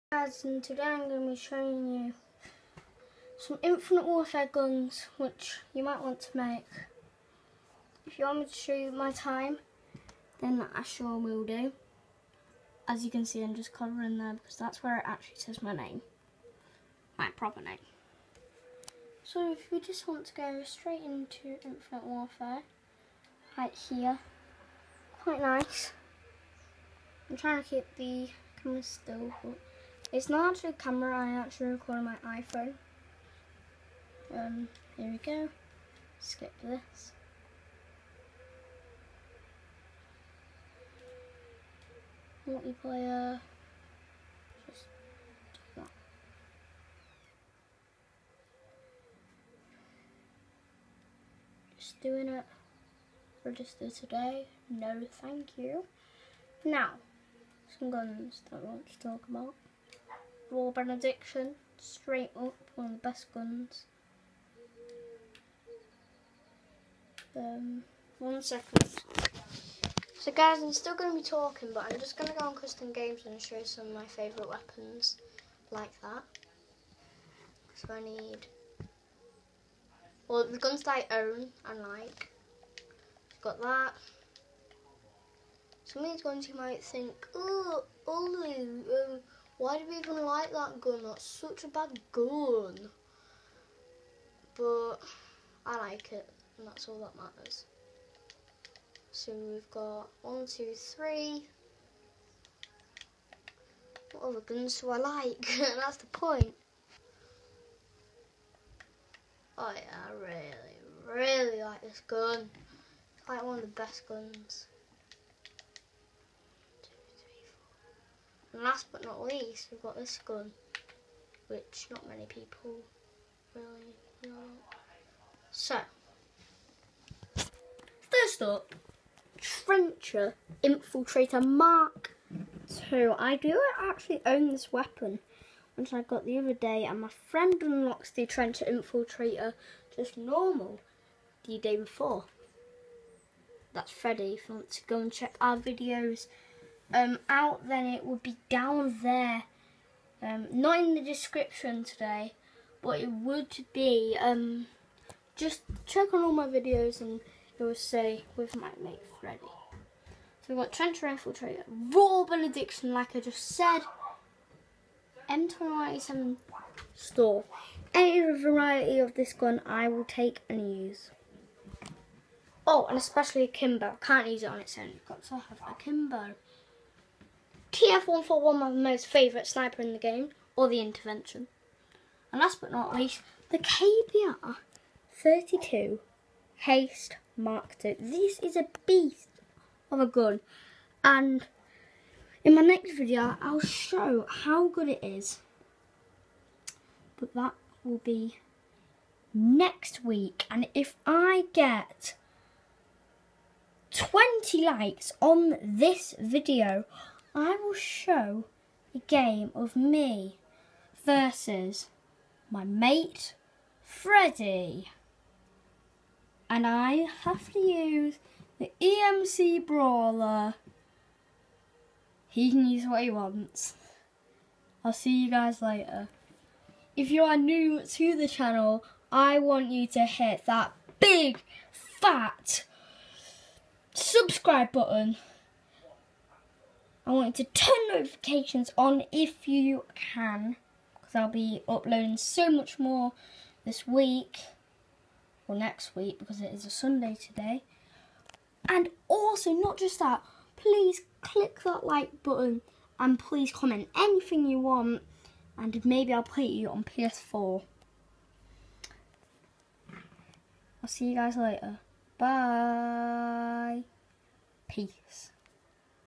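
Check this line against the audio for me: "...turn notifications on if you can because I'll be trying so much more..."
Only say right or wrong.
wrong.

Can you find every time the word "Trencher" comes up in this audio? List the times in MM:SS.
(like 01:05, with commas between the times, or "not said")
02:09, 02:18, 02:40.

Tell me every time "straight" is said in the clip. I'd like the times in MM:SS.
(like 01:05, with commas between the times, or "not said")
00:20, 01:01.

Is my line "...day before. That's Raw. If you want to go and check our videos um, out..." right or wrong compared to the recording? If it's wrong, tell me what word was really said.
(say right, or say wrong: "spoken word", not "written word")
wrong: "Freddy", not "Raw".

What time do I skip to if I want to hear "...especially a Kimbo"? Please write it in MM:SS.
02:52.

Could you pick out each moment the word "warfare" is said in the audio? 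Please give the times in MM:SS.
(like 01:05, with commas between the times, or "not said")
00:04, 00:22.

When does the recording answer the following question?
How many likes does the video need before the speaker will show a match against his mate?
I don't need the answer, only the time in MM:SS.
03:23.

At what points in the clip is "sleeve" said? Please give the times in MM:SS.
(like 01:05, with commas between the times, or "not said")
not said.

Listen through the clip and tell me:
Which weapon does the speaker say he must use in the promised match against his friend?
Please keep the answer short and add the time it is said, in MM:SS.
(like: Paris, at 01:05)
EMC Brawler, at 03:38.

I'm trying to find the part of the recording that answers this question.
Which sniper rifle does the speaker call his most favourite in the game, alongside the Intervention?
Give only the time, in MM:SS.
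02:57.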